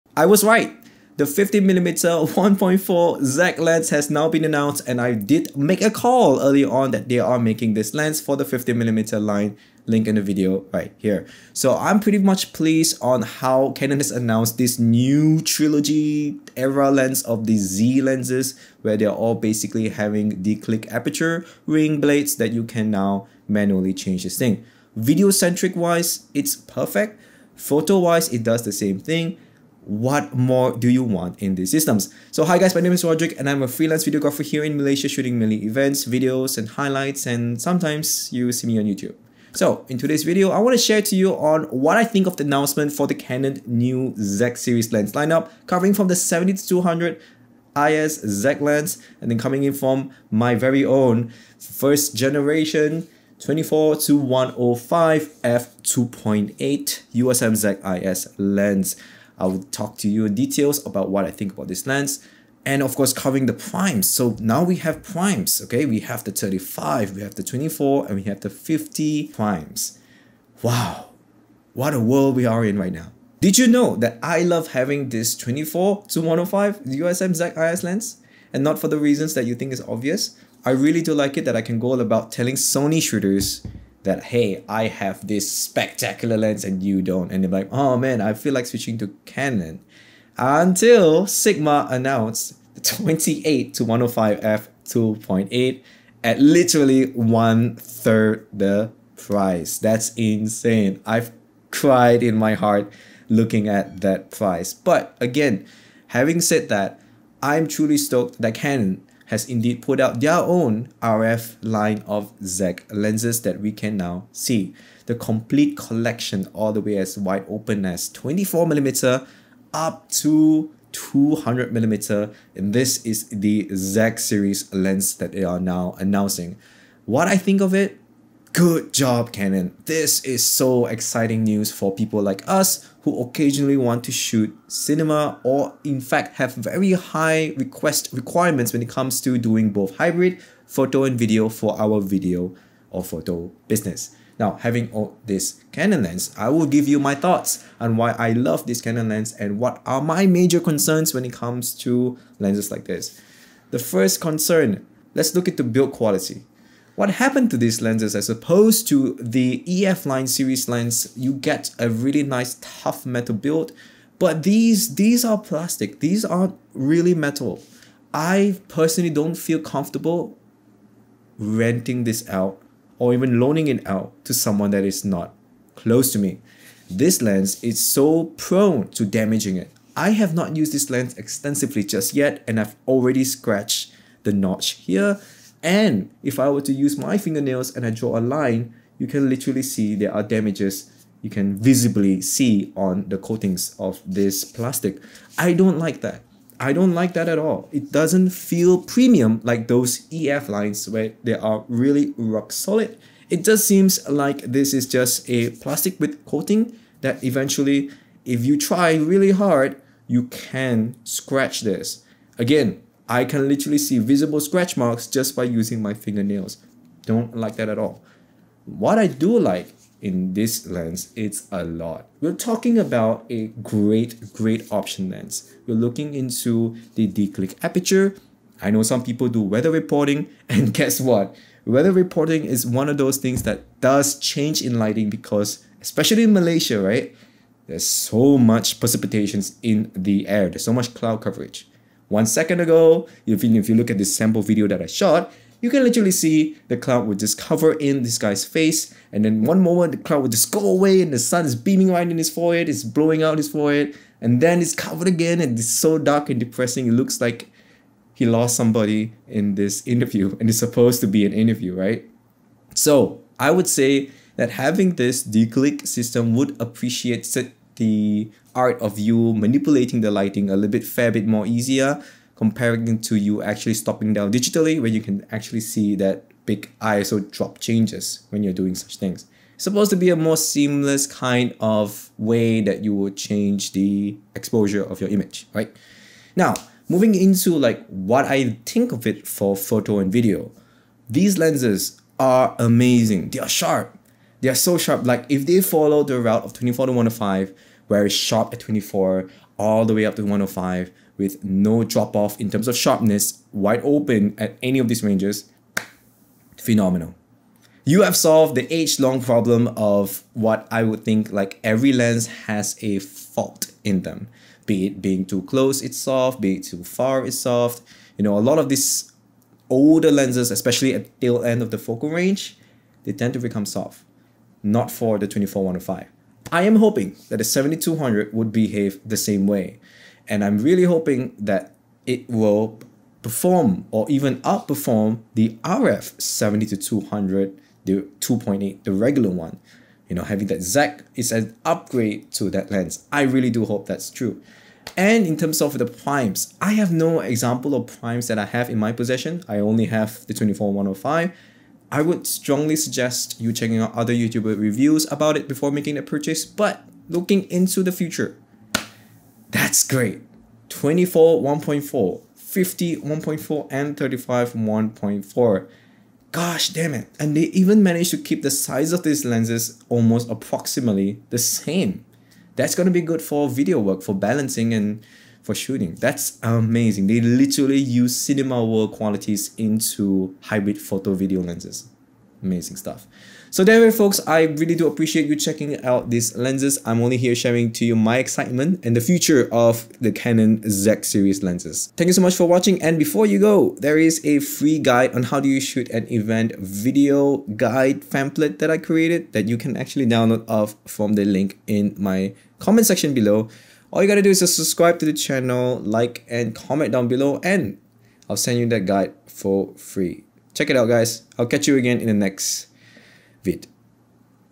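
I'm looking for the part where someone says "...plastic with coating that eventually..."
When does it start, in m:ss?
3:25.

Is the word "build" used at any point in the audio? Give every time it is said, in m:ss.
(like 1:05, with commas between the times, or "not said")
2:35, 2:43.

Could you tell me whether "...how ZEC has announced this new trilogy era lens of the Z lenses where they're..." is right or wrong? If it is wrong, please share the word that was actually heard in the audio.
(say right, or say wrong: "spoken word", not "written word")
wrong: "Canon", not "ZEC".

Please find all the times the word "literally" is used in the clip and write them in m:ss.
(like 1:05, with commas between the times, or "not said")
1:36, 3:09, 3:33, 4:05, 6:17.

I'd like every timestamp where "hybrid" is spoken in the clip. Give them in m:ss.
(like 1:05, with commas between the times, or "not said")
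2:19, 6:20.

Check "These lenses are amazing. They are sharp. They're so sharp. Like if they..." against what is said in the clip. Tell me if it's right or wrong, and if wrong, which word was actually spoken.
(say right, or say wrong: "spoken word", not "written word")
right.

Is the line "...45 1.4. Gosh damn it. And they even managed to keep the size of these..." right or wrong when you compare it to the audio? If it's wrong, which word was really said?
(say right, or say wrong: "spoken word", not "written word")
wrong: "35", not "45".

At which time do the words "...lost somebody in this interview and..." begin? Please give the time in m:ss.
4:18.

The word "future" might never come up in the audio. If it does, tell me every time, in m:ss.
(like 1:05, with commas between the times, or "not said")
5:57, 6:29.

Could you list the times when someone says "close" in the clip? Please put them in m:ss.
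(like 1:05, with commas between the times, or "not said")
2:55, 5:15.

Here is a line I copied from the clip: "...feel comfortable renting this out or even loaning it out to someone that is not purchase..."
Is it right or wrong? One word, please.
wrong.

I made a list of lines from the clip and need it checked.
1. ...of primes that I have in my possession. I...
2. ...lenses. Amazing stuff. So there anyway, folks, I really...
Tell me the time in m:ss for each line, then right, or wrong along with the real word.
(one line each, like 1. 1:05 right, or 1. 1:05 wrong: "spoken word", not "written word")
1. 5:47 right
2. 6:21 right.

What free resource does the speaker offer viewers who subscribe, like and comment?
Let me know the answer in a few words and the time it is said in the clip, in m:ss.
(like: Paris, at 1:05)
Event video guide, at 6:36.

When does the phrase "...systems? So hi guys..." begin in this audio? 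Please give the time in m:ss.
0:31.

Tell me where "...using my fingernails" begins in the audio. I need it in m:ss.
3:35.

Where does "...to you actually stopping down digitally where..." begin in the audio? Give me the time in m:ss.
4:32.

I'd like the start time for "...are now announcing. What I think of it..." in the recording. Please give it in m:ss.
2:05.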